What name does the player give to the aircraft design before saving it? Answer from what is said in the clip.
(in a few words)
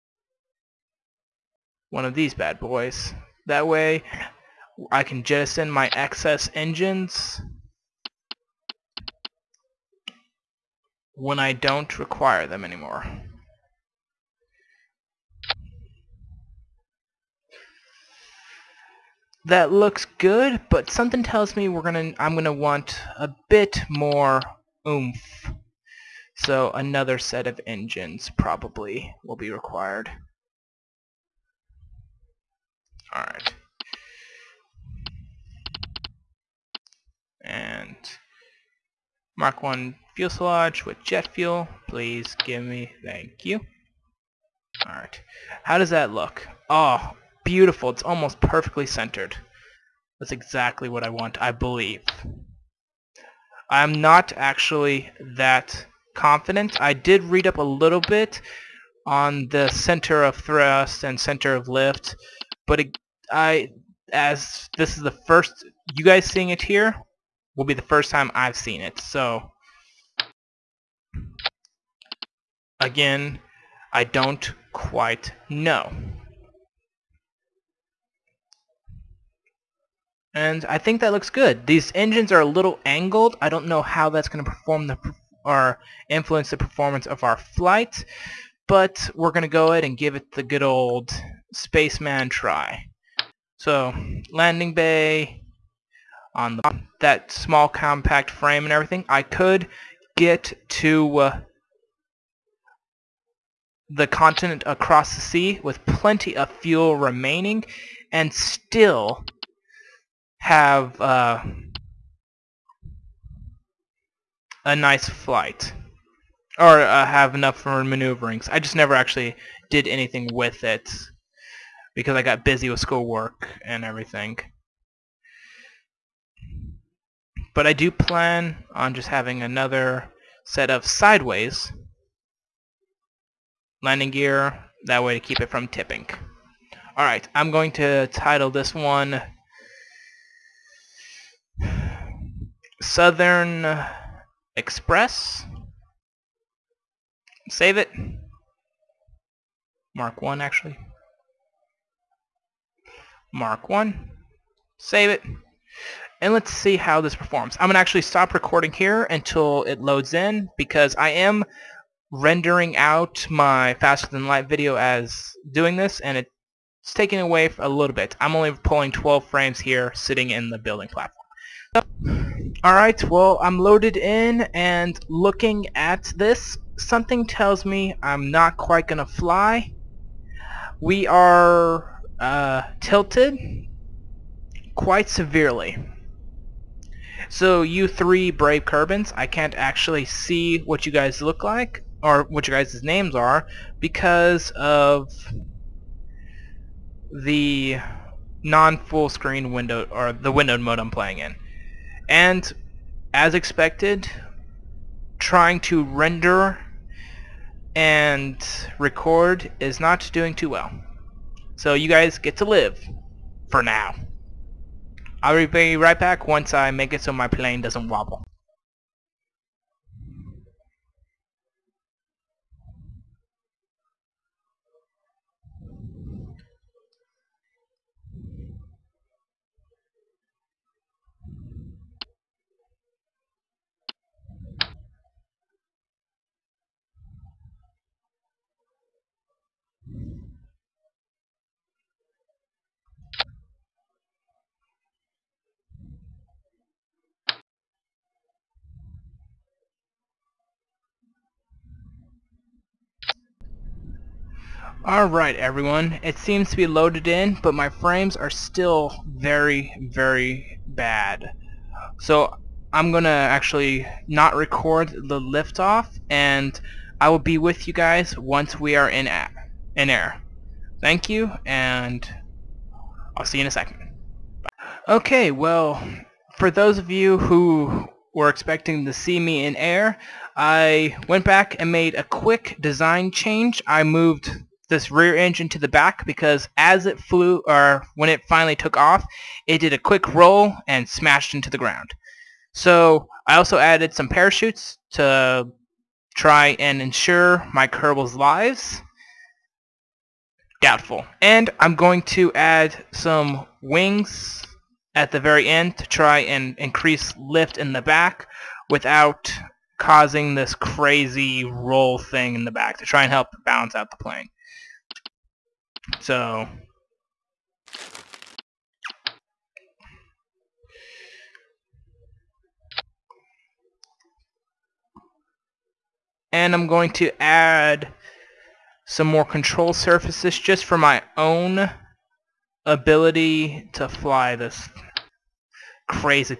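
Southern Express.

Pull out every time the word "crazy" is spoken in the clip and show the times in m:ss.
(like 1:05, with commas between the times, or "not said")
5:10, 5:35.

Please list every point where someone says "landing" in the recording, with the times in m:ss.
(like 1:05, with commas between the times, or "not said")
1:34, 2:13.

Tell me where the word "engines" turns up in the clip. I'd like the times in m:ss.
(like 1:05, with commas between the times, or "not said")
0:06, 0:27, 1:21, 4:45.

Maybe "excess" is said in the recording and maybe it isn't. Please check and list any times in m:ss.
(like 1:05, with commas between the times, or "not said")
0:05.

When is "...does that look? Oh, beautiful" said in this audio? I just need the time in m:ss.
0:45.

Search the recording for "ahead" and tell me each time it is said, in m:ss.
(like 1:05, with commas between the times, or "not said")
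1:29.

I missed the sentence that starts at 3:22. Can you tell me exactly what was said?
And as expected, trying to render and record is not doing too well.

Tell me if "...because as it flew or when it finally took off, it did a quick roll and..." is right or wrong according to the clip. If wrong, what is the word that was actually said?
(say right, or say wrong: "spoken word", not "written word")
right.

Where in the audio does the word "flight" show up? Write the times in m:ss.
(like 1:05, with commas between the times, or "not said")
1:27, 1:55.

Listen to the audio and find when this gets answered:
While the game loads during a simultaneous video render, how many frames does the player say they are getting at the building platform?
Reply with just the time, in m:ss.
2:48.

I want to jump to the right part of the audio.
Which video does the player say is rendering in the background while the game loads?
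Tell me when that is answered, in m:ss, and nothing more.
2:43.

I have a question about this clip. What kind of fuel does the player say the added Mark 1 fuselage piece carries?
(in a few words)
Jet fuel.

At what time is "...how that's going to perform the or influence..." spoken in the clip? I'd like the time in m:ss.
1:23.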